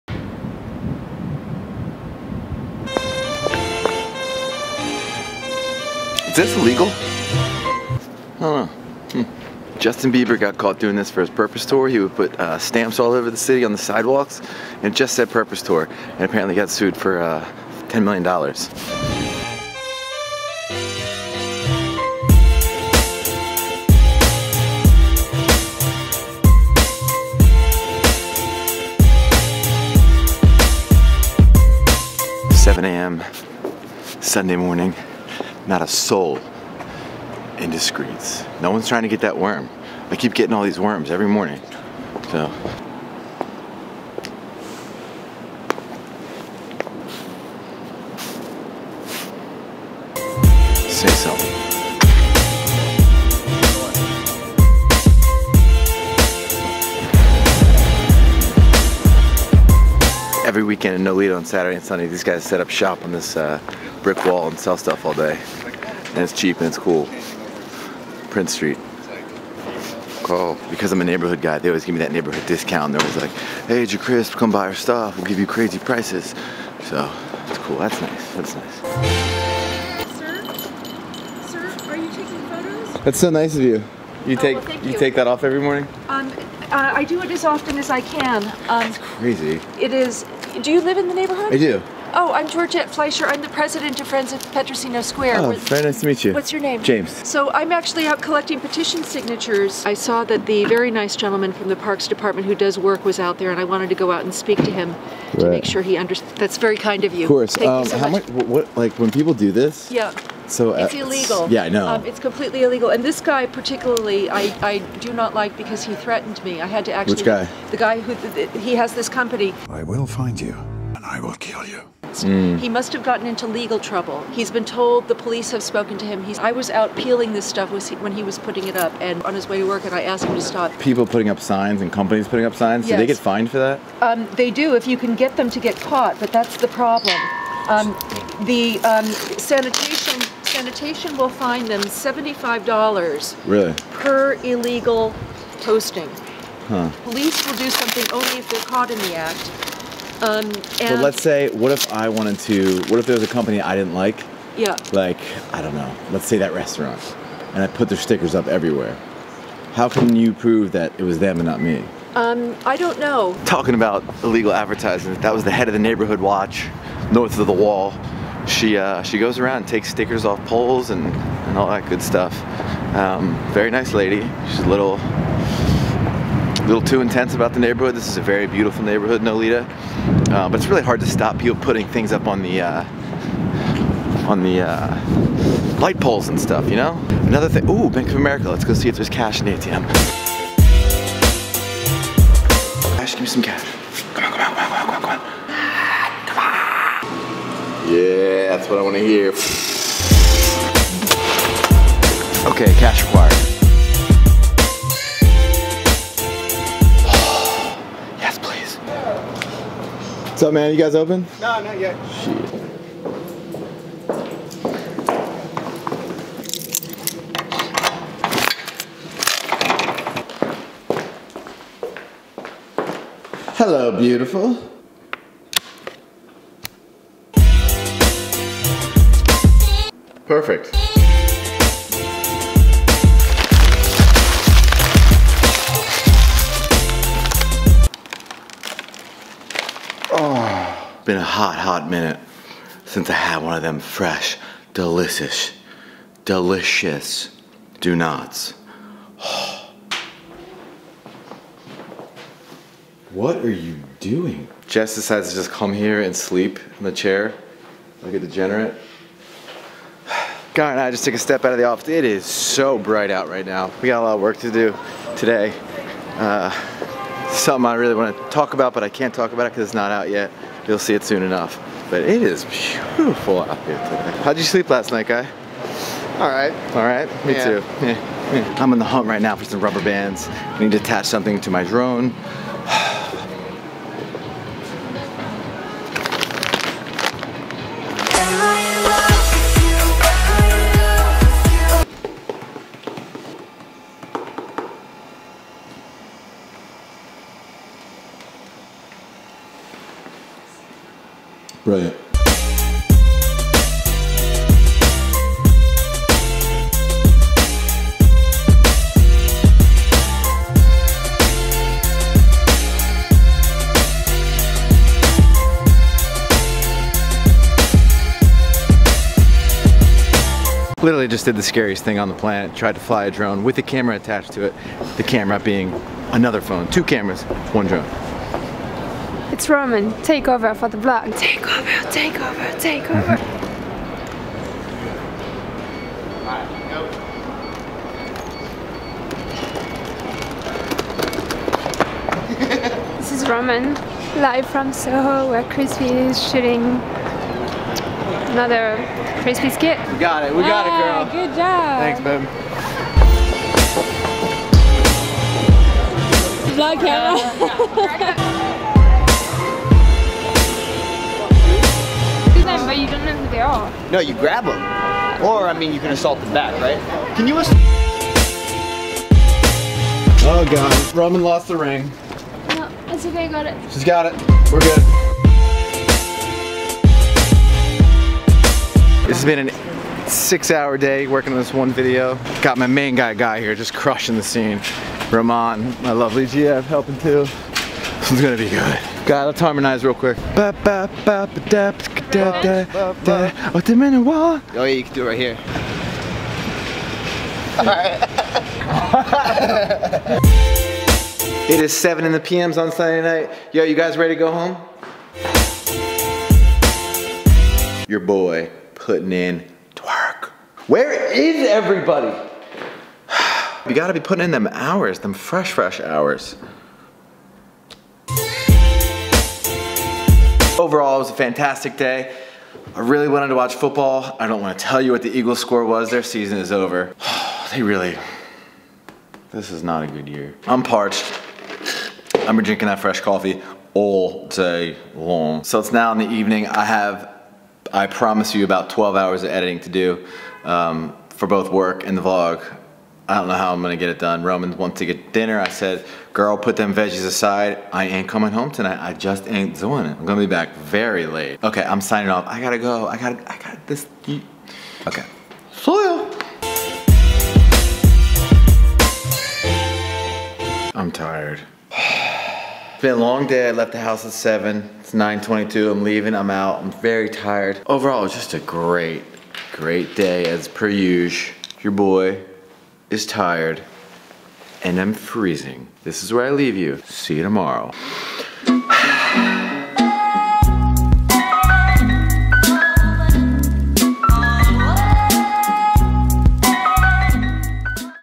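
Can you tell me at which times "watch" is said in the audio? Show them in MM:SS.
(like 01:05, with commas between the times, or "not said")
02:46, 07:03.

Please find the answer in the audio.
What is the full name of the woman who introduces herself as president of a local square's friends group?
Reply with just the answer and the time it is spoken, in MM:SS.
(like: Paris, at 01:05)
Georgette Fleischer, at 01:32.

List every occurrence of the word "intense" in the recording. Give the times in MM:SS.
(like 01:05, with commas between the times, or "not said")
02:57.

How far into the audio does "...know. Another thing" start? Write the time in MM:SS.
03:06.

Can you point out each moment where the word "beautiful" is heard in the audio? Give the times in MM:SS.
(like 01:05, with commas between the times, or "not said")
02:58, 03:43, 04:32.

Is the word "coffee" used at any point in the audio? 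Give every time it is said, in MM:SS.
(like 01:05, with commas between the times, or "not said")
07:12.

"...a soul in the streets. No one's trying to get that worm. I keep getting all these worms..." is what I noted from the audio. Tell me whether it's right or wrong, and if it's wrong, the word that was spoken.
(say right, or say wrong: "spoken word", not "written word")
right.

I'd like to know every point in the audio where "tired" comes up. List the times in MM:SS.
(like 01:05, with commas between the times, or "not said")
07:47, 07:53.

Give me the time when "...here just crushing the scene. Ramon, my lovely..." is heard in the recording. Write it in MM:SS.
06:23.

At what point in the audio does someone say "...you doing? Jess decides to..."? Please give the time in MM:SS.
04:13.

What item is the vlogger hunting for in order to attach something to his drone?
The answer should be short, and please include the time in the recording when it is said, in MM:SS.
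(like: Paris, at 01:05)
Rubber bands, at 04:39.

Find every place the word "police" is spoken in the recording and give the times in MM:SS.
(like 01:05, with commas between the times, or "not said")
02:05, 02:27.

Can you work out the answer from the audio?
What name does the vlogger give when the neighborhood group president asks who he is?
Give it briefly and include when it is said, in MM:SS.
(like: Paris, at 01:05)
James, at 01:36.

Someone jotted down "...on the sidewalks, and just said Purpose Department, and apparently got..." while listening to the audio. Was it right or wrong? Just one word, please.
wrong.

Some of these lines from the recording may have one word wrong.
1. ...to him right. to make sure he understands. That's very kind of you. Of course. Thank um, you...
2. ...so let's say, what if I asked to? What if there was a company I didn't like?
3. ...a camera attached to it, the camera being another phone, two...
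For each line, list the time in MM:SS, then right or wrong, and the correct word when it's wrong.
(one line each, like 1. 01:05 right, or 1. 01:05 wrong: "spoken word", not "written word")
1. 01:44 right
2. 02:30 wrong: "wanted", not "asked"
3. 05:23 right.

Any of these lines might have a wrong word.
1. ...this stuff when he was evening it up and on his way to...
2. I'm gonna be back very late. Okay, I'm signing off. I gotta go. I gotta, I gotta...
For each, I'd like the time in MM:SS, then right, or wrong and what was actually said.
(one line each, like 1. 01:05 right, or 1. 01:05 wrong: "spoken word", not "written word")
1. 02:07 wrong: "putting", not "evening"
2. 07:29 right.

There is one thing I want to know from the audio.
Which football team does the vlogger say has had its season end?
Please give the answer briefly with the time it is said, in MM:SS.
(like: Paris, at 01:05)
Eagles, at 07:05.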